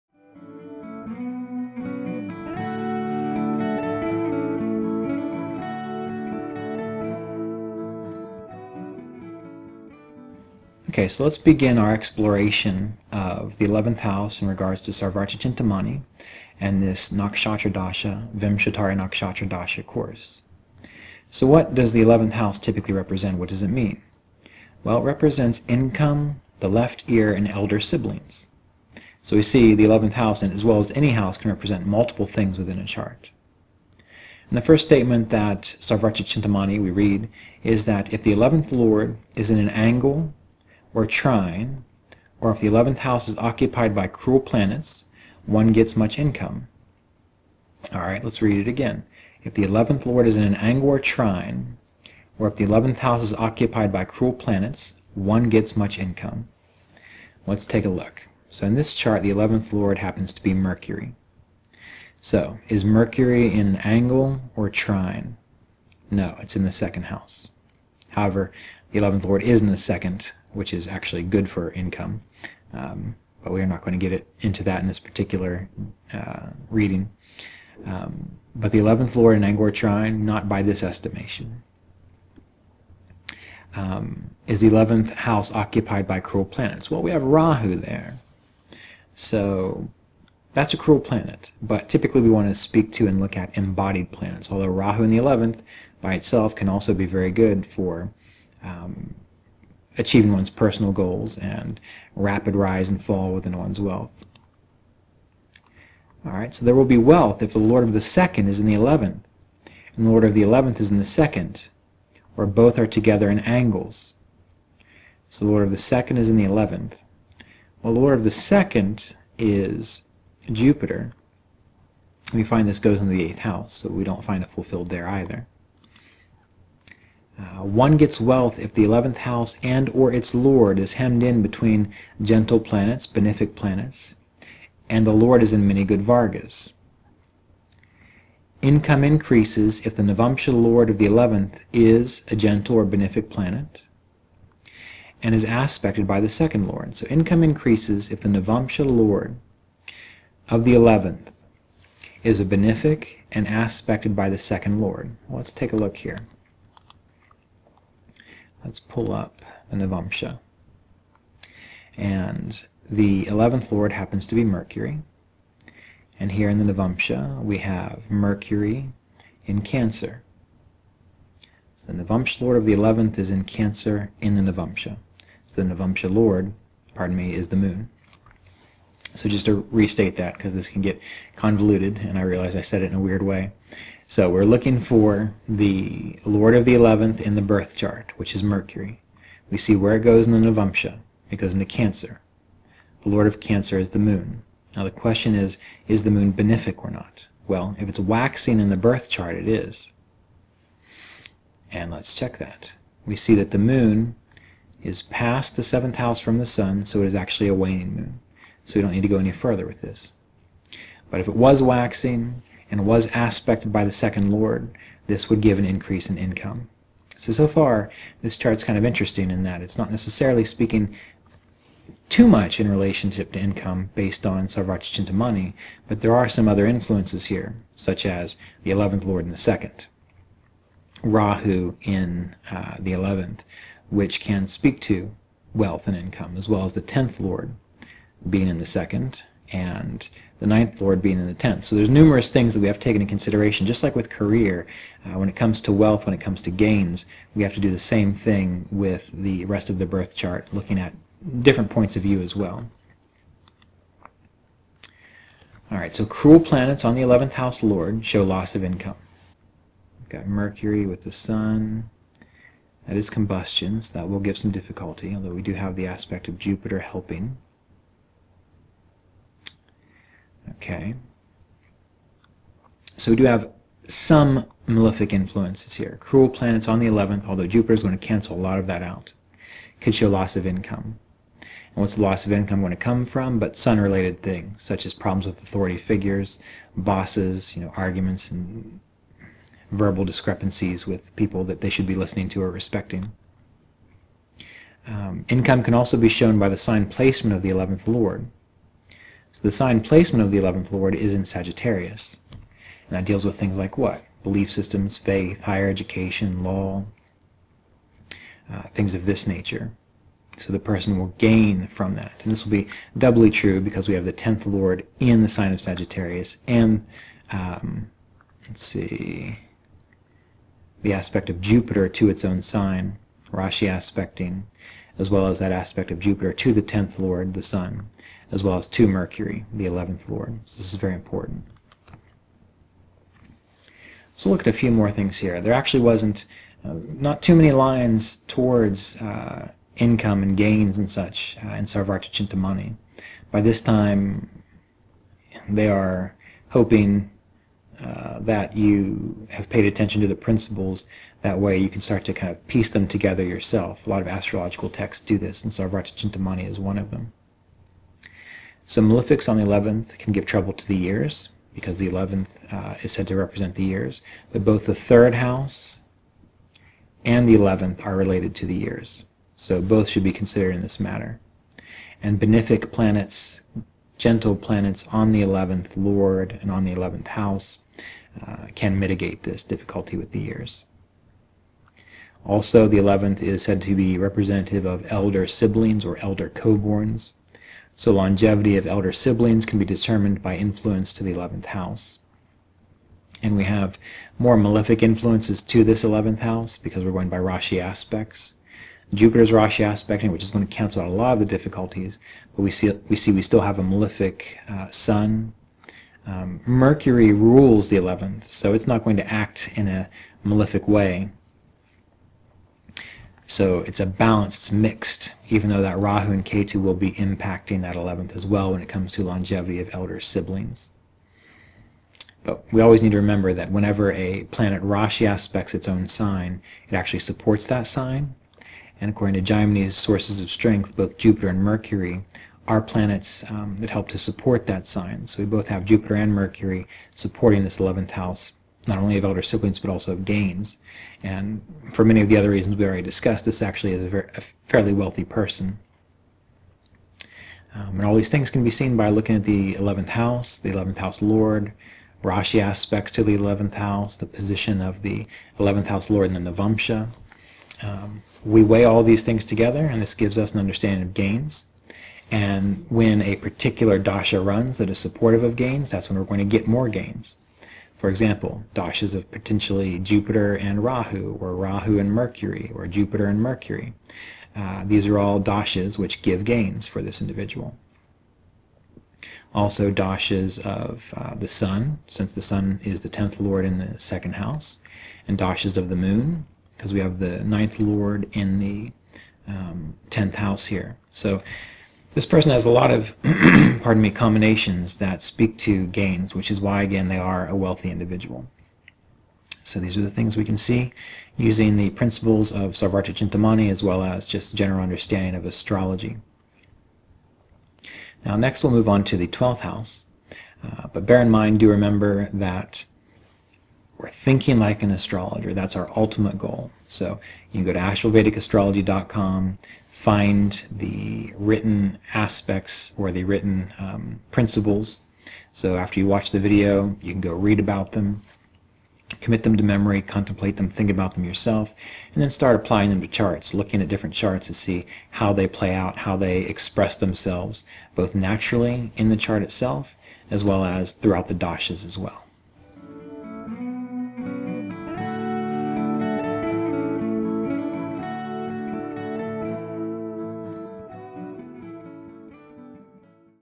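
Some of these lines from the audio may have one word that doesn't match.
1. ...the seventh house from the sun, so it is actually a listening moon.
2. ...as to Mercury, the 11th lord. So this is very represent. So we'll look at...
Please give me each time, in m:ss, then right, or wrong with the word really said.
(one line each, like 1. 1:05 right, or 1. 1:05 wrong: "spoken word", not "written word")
1. 3:25 wrong: "waning", not "listening"
2. 5:28 wrong: "important", not "represent".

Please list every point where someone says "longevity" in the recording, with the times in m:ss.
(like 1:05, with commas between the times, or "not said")
6:27, 6:59.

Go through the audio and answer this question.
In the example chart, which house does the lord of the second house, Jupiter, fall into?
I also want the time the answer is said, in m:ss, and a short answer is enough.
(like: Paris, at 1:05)
Eighth house, at 2:02.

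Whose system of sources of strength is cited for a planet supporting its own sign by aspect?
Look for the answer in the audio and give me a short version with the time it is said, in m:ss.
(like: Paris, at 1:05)
Jaimini, at 7:08.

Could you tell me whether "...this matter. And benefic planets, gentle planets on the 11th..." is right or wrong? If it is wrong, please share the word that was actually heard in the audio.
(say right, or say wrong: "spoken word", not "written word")
right.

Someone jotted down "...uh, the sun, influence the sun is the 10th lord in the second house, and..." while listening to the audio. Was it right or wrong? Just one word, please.
wrong.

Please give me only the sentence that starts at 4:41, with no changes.
And what's the loss of income going to come from?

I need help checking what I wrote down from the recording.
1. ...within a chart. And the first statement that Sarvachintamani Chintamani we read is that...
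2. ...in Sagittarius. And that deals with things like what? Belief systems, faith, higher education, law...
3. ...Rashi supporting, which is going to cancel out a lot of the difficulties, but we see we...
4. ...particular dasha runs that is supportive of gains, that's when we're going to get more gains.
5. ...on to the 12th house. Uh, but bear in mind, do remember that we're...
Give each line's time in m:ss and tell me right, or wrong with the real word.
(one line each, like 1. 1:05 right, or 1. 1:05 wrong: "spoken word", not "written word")
1. 0:32 right
2. 5:01 right
3. 6:39 wrong: "aspecting", not "supporting"
4. 7:43 right
5. 8:28 right.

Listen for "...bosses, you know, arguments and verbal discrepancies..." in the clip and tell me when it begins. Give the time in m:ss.
4:46.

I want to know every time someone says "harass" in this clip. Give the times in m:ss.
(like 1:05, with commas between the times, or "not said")
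not said.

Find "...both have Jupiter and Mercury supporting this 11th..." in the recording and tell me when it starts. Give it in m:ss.
7:15.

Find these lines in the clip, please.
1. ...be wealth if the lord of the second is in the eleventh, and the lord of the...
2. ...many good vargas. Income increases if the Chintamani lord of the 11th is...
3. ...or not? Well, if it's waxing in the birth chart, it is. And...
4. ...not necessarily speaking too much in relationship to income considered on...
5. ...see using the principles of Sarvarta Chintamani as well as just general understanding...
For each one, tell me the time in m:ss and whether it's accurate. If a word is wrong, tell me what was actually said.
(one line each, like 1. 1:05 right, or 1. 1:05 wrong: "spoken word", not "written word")
1. 1:46 right
2. 2:15 wrong: "Navamsha", not "Chintamani"
3. 3:16 right
4. 3:39 wrong: "based", not "considered"
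5. 8:20 right.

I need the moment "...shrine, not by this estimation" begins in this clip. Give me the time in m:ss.
1:19.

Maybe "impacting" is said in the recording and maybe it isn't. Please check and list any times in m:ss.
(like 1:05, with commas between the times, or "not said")
6:56.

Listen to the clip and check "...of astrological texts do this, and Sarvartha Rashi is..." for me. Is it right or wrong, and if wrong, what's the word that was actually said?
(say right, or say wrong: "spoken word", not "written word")
wrong: "Chintamani", not "Rashi".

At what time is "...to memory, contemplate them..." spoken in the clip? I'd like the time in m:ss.
8:49.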